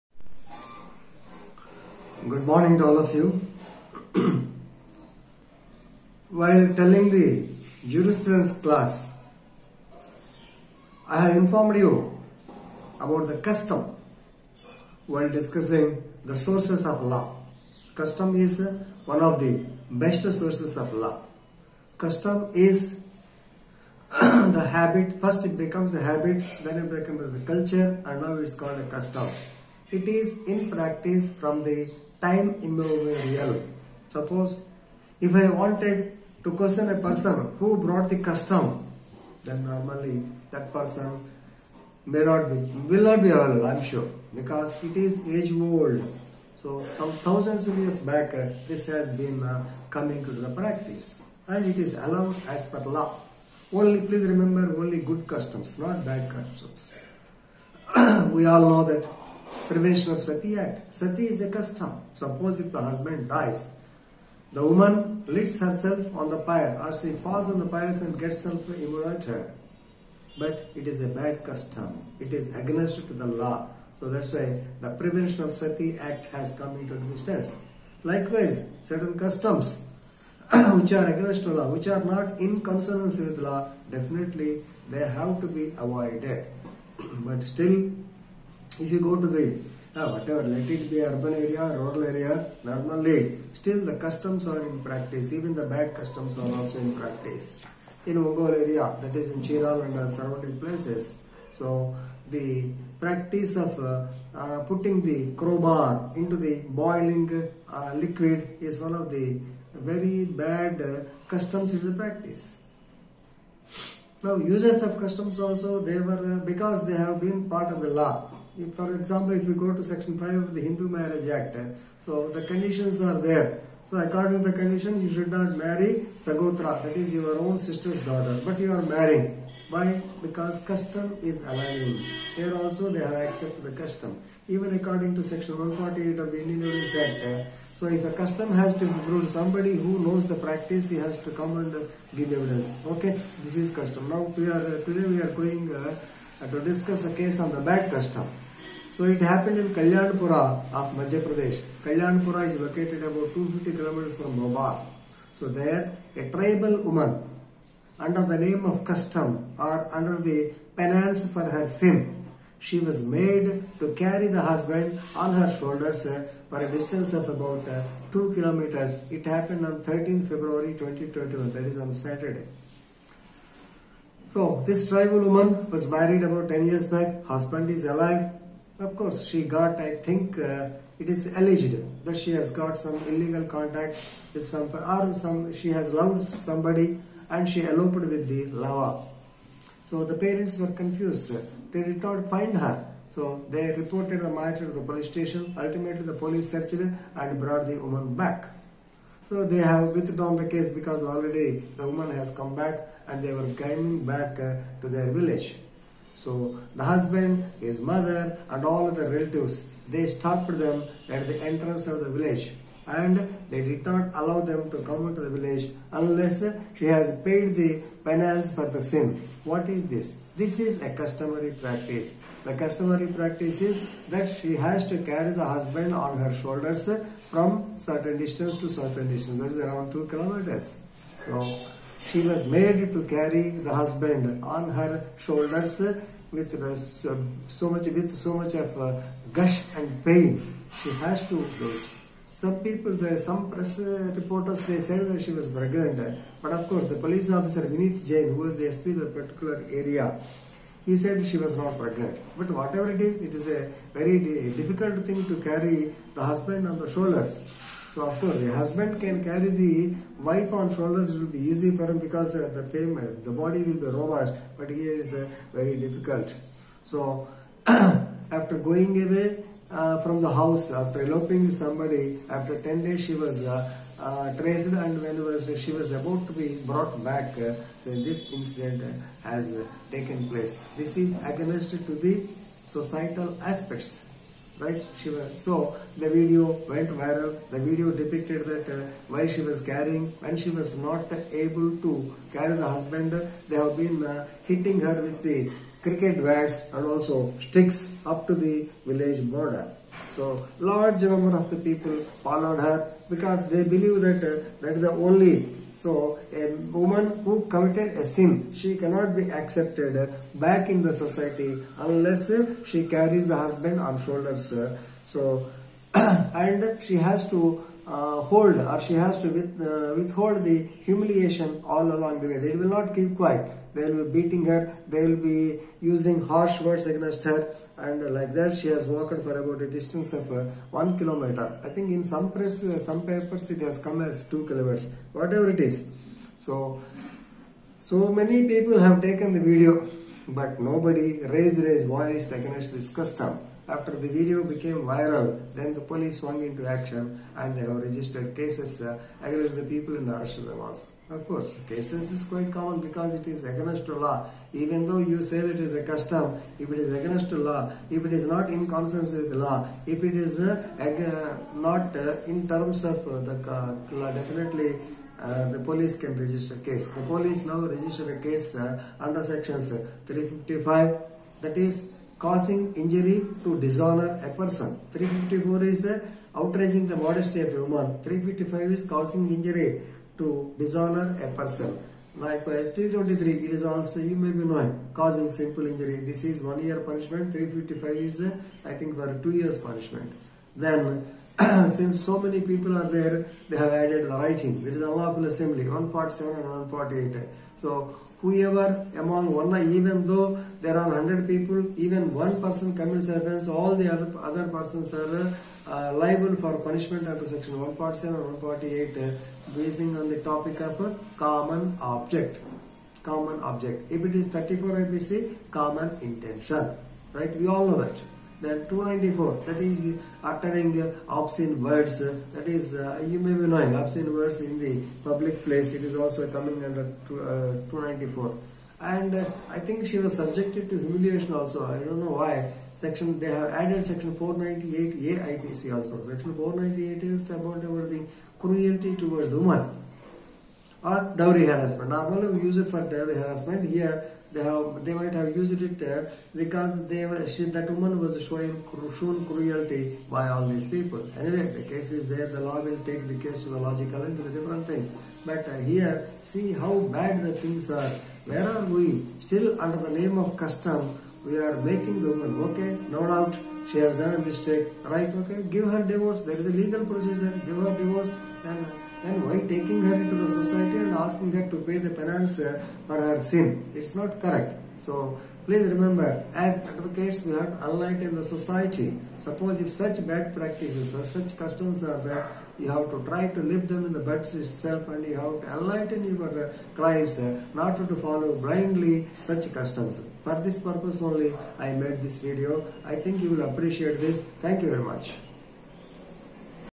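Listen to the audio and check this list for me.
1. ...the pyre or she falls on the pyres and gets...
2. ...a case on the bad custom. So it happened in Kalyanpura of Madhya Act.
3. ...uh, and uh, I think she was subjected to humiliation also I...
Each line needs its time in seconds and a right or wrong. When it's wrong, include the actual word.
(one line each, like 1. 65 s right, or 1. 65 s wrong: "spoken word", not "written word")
1. 66 s right
2. 147 s wrong: "Pradesh", not "Act"
3. 428 s right.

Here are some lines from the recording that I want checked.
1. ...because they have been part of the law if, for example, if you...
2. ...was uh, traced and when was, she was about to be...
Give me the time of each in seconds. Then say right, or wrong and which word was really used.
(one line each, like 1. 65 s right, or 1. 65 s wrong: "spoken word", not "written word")
1. 116 s right
2. 273 s right.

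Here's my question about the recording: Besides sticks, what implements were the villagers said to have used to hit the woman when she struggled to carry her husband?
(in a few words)
cricket bats.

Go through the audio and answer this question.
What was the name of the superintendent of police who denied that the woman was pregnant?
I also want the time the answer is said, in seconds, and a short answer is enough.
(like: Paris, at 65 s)
Vinith Jain, at 247 s.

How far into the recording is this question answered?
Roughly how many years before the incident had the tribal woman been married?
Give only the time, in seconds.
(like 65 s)
176 s.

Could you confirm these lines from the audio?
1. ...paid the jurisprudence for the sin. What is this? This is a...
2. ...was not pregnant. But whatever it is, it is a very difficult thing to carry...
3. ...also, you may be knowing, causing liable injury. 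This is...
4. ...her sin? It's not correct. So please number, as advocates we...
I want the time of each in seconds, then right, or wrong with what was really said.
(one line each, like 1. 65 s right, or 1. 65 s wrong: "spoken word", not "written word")
1. 217 s wrong: "penance", not "jurisprudence"
2. 251 s right
3. 383 s wrong: "simple", not "liable"
4. 473 s wrong: "remember", not "number".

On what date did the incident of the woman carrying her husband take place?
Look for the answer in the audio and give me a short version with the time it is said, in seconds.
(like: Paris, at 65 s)
13 February 2021, at 169 s.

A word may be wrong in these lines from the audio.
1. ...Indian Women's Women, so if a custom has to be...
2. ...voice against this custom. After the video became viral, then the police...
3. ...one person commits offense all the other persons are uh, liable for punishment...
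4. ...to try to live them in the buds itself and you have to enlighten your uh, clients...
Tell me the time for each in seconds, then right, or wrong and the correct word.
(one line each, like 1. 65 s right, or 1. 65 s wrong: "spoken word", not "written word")
1. 136 s wrong: "Act", not "Women"
2. 341 s right
3. 402 s right
4. 482 s right.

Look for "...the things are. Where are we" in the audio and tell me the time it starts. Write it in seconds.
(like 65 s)
457 s.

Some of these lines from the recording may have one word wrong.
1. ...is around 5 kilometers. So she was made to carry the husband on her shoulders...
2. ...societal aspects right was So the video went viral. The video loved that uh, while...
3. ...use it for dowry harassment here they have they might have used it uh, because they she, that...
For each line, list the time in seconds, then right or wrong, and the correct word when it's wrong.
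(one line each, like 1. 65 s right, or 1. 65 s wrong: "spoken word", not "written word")
1. 229 s wrong: "2", not "5"
2. 282 s wrong: "depicted", not "loved"
3. 442 s right.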